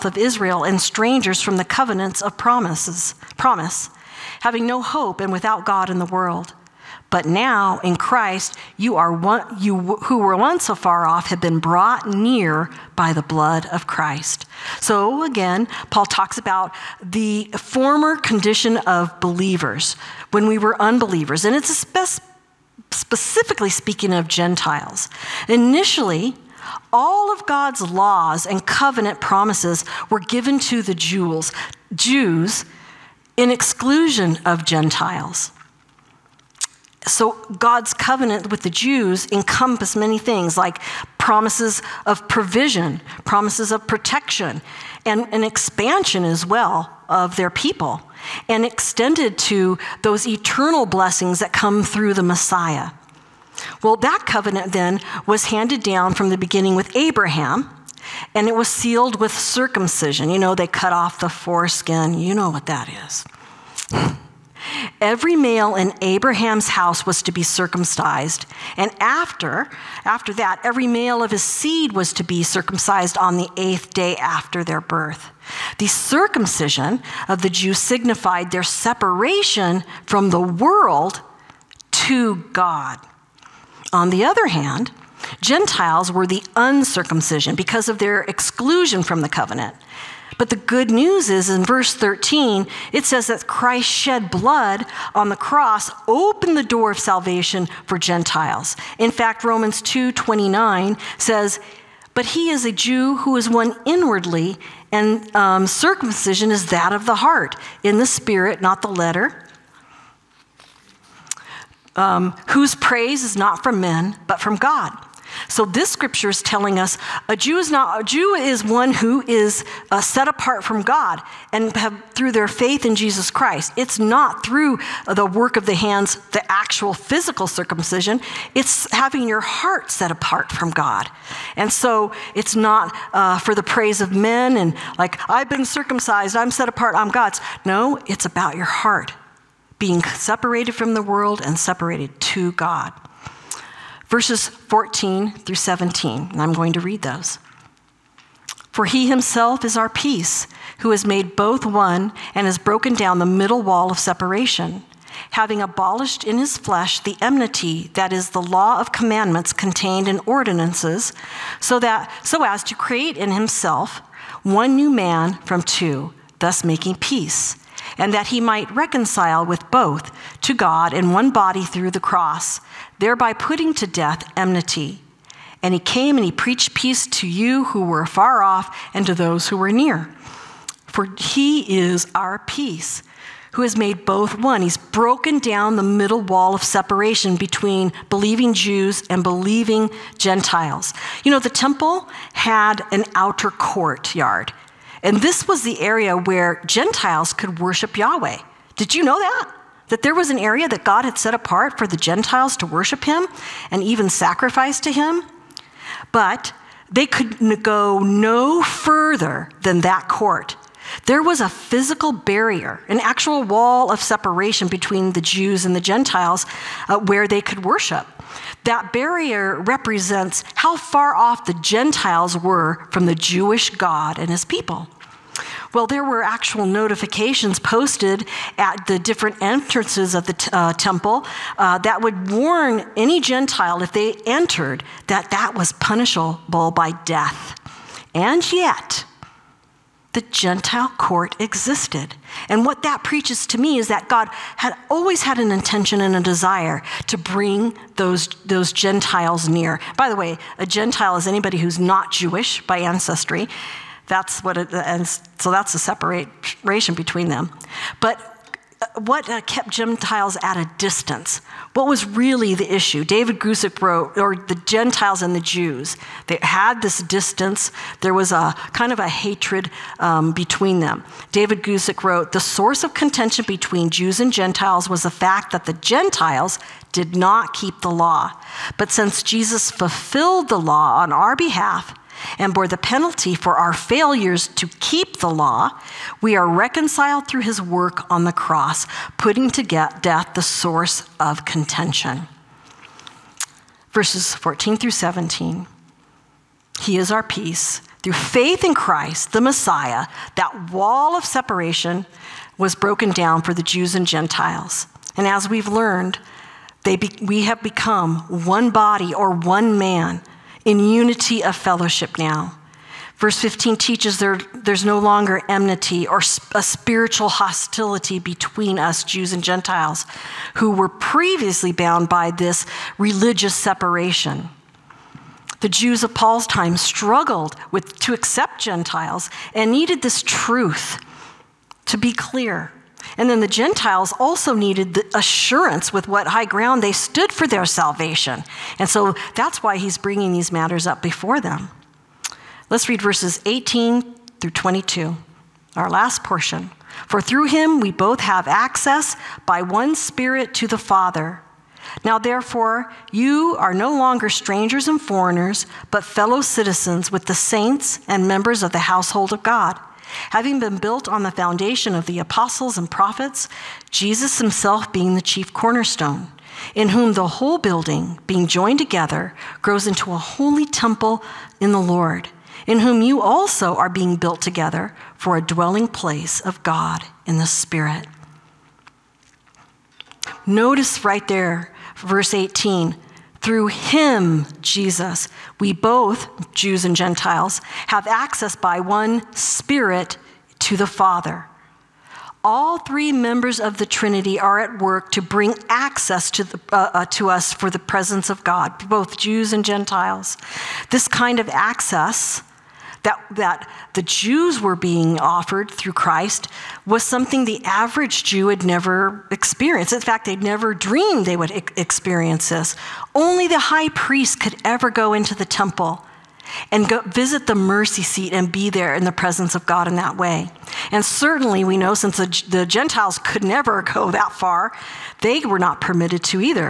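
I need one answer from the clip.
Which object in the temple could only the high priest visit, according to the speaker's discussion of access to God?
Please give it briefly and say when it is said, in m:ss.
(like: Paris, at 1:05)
the mercy seat, at 6:57.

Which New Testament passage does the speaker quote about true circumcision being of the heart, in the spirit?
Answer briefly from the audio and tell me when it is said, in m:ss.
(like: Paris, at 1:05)
Romans 2:29, at 1:39.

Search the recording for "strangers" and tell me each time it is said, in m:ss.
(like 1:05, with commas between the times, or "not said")
0:00, 5:54.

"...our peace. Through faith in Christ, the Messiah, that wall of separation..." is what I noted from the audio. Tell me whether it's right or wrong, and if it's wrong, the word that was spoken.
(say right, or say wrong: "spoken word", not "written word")
right.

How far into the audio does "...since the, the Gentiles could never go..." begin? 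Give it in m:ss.
7:01.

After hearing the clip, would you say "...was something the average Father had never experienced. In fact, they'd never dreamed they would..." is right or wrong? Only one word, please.
wrong.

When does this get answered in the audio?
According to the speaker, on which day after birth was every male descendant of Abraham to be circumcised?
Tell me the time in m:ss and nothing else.
1:13.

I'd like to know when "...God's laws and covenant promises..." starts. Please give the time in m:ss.
0:27.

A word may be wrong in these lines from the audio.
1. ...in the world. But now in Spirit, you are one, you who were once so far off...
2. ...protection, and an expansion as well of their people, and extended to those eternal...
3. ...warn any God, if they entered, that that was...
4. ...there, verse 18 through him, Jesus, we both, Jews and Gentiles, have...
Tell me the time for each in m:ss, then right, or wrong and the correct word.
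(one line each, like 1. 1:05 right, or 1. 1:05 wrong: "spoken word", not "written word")
1. 0:05 wrong: "Christ", not "Spirit"
2. 0:43 right
3. 3:52 wrong: "Gentile", not "God"
4. 6:21 right.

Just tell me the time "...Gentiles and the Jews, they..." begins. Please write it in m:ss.
4:24.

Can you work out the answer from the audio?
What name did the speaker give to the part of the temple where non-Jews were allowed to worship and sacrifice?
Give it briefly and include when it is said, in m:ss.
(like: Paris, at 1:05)
outer courtyard, at 3:13.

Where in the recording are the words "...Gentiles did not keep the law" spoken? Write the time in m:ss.
4:35.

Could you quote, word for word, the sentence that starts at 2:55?
And he came and he preached peace to you who were far off and to those who were near.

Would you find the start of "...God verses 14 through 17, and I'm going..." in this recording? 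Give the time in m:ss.
2:22.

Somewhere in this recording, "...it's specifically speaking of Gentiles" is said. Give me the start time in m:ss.
0:21.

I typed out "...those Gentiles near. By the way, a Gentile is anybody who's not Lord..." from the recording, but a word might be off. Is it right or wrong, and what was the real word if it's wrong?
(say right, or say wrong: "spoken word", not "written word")
wrong: "Jewish", not "Lord".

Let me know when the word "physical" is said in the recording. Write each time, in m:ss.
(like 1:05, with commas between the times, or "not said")
2:06, 3:31.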